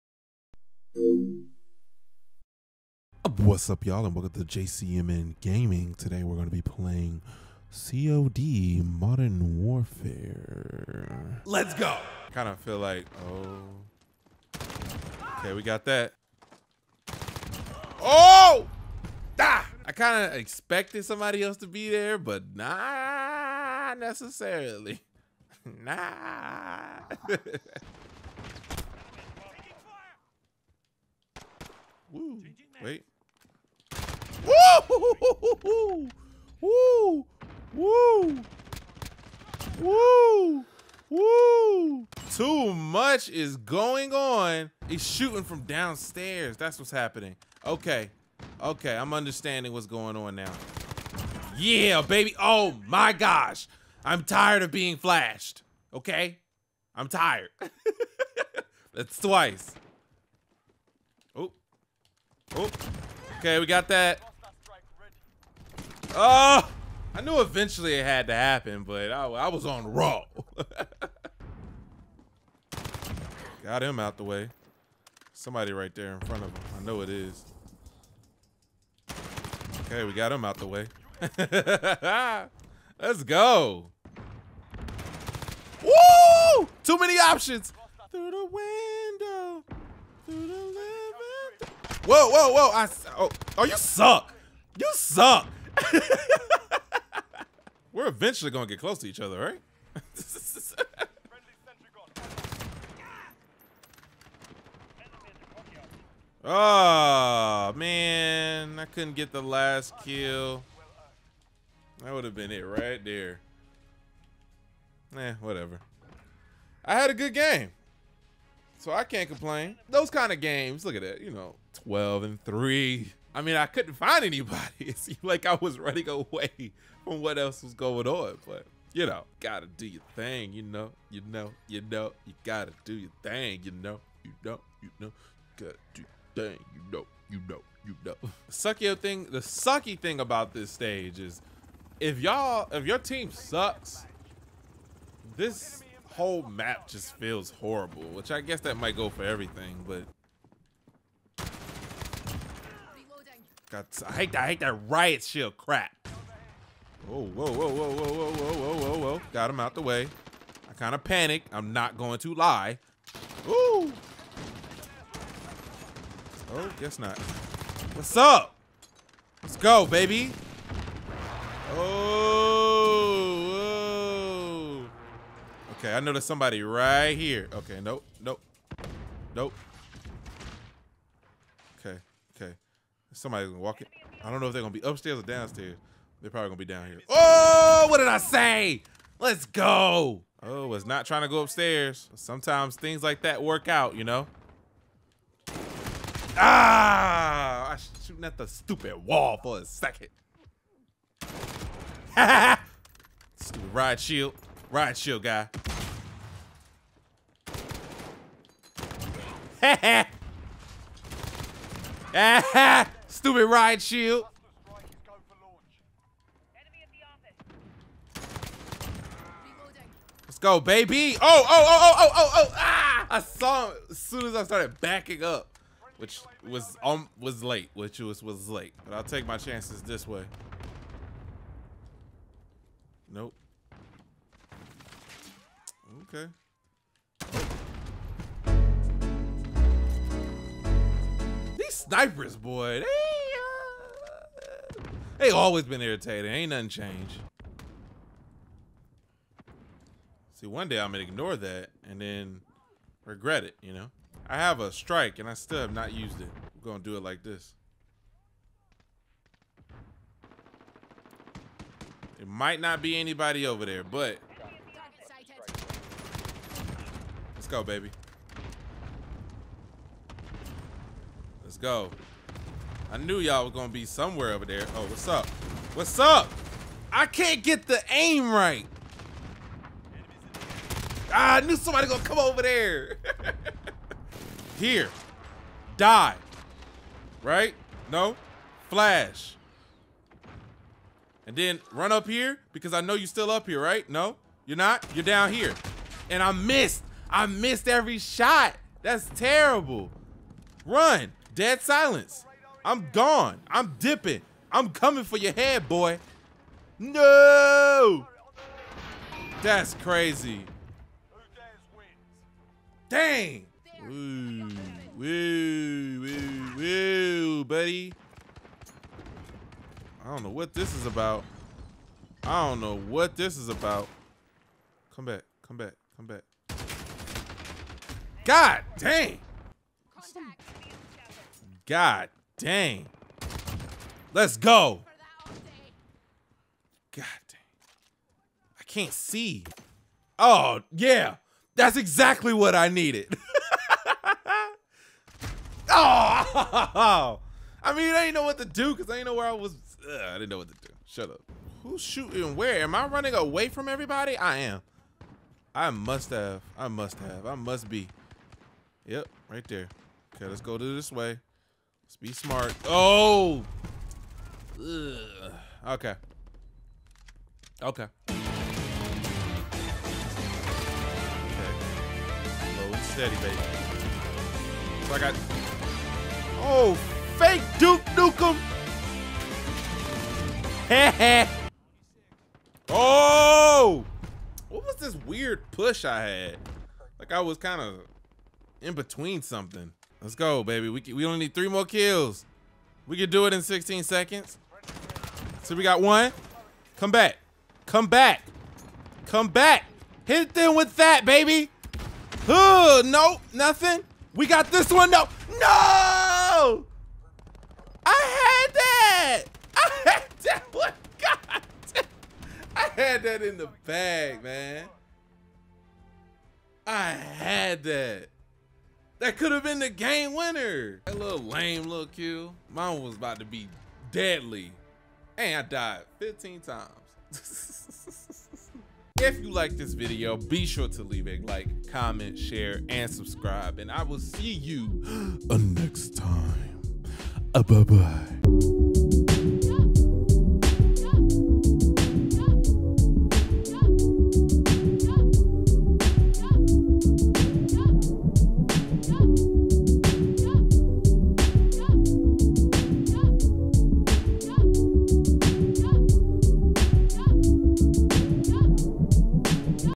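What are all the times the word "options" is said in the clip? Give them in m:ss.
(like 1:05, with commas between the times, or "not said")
1:27.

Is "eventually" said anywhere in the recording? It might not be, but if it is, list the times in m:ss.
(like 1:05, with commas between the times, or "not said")
1:07, 1:38.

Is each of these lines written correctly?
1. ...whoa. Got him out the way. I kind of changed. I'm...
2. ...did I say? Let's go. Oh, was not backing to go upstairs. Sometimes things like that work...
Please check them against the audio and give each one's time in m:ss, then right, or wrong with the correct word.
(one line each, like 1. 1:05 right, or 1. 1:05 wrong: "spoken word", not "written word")
1. 2:38 wrong: "panicked", not "changed"
2. 3:07 wrong: "trying", not "backing".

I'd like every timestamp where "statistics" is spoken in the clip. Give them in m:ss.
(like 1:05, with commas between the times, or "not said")
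not said.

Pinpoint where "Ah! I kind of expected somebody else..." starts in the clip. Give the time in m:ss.
0:19.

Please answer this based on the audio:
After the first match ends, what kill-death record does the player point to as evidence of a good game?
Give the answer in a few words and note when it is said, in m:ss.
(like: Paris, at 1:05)
12 and 3, at 2:01.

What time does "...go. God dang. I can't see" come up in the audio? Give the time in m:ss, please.
5:34.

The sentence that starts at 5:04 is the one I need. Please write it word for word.
I'm coming for your head, boy.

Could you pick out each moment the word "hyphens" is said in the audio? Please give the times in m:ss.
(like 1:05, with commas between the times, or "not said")
not said.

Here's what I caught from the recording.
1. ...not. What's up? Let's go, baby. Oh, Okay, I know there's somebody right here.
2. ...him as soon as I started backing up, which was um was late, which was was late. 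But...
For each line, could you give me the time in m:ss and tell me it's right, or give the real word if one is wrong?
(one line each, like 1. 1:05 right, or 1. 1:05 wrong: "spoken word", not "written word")
1. 2:46 right
2. 3:43 right.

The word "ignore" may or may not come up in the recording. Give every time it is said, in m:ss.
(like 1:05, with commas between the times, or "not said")
4:11.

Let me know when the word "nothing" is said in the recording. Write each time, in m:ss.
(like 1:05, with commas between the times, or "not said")
4:06, 6:43.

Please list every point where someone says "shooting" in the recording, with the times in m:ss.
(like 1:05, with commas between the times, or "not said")
0:45, 3:18, 5:51.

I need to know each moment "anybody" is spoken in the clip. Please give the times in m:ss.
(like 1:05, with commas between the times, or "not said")
2:04, 4:22.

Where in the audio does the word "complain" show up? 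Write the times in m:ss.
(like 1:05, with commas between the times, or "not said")
1:59.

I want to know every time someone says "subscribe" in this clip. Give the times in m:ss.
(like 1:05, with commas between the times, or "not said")
7:12.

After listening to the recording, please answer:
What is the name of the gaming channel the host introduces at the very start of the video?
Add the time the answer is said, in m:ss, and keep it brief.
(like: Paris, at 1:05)
JCMN Gaming, at 0:04.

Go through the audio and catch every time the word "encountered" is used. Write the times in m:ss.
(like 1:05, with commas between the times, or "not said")
not said.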